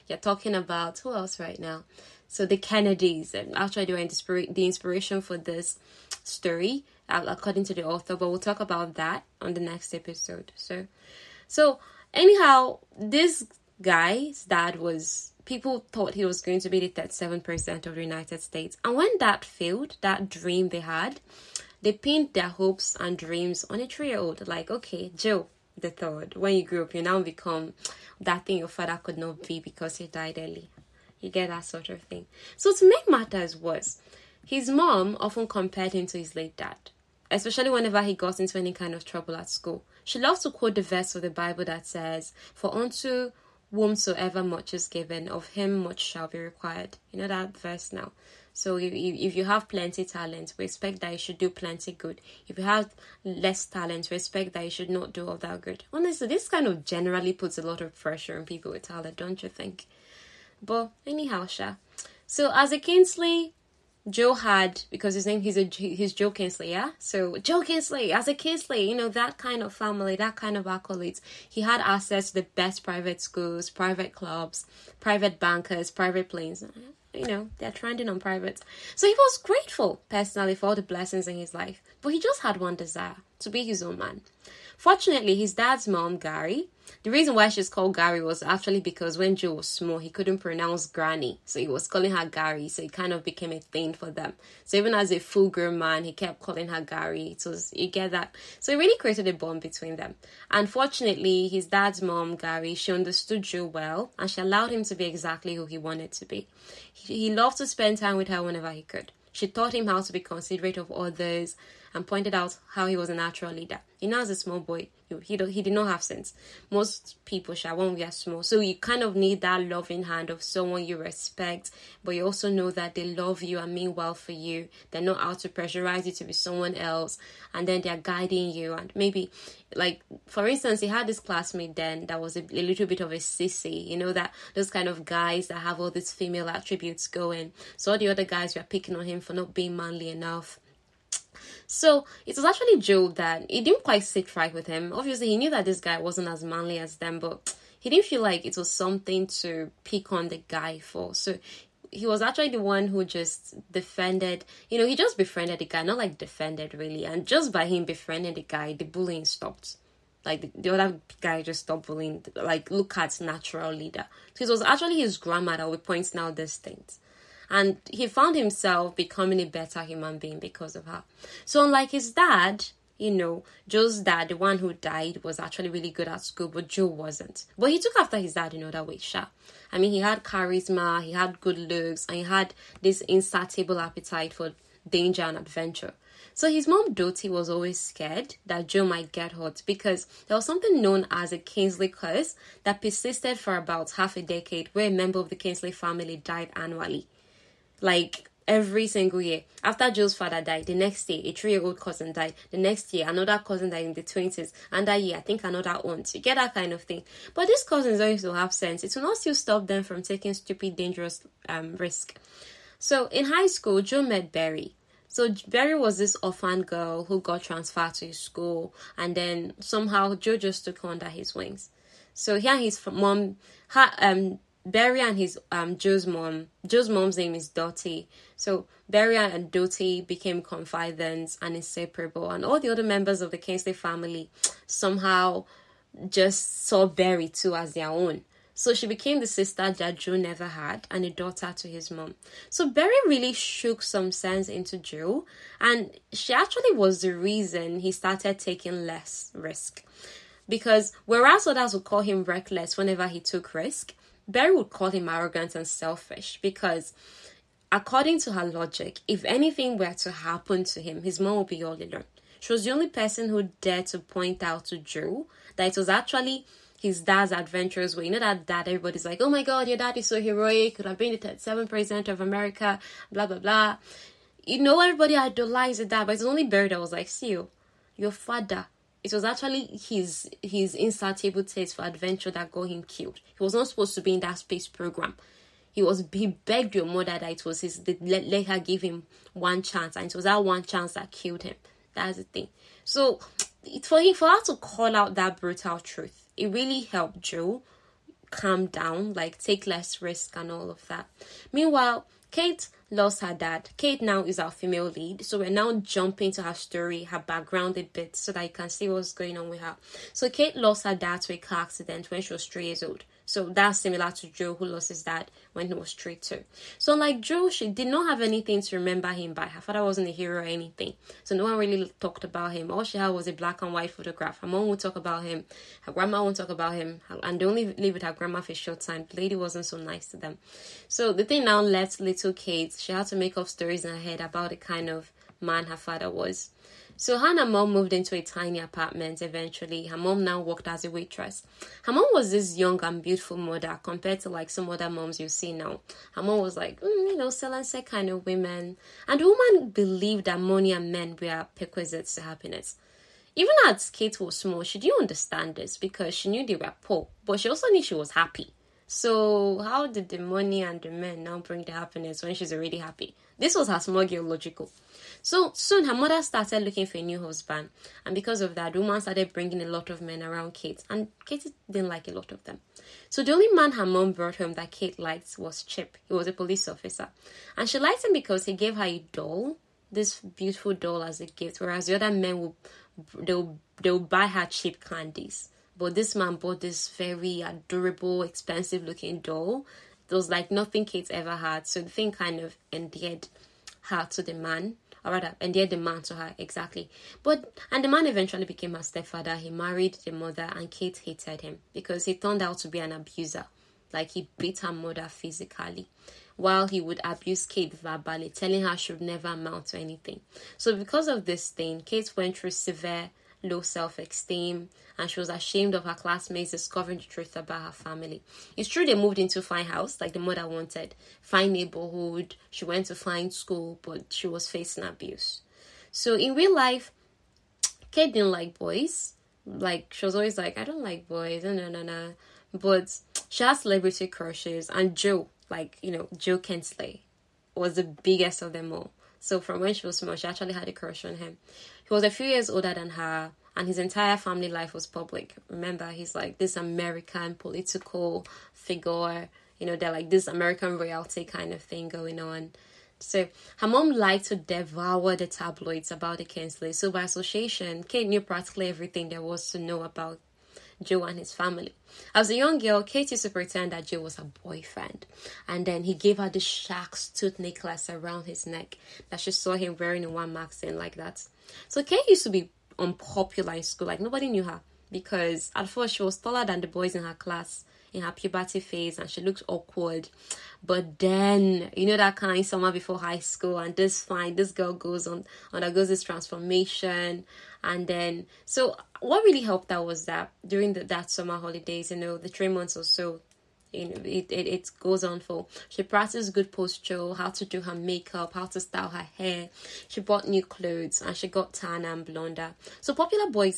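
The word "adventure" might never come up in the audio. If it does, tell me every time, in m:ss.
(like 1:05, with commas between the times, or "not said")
3:05, 4:27, 4:41.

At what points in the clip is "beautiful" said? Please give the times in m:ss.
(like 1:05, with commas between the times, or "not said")
5:43, 6:20.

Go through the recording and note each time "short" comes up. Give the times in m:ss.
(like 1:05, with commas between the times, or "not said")
5:28.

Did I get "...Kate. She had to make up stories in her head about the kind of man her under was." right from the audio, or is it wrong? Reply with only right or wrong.
wrong.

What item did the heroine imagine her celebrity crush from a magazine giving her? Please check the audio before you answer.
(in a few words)
Shark's tooth necklace.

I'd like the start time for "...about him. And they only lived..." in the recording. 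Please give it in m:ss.
5:26.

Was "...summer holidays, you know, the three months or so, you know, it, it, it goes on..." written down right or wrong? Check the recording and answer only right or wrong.
right.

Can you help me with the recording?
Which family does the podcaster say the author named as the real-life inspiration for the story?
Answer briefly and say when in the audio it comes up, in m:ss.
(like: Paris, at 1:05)
The Kennedys, at 0:02.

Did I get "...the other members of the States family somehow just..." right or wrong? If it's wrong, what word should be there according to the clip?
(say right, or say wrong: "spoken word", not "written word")
wrong: "Kingsley", not "States".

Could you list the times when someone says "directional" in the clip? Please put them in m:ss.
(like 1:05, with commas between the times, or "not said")
not said.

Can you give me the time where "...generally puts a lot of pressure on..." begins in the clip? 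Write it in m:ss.
0:56.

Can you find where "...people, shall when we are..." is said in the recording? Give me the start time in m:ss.
1:57.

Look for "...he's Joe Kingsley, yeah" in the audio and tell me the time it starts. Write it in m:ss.
1:05.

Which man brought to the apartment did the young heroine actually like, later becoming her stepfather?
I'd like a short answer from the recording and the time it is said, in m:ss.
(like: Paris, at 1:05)
Chip, at 6:15.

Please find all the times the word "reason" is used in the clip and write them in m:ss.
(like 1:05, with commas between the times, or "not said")
1:27, 4:07.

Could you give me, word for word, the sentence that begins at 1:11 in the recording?
He had access to the best private schools, private clubs, private bankers, private planes.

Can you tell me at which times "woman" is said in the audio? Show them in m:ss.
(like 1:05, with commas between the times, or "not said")
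5:49, 6:08.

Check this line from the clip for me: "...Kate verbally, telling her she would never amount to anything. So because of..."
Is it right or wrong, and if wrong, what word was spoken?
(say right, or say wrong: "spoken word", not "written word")
right.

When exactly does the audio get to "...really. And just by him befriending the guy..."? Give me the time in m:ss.
2:36.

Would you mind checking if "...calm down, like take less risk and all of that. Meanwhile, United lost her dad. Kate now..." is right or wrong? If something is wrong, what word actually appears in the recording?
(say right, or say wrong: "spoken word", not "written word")
wrong: "Kate", not "United".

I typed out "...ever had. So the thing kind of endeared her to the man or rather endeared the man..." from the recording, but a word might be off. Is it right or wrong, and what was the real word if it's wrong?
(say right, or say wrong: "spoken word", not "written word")
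right.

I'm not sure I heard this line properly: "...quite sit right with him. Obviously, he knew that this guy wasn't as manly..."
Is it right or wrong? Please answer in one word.
right.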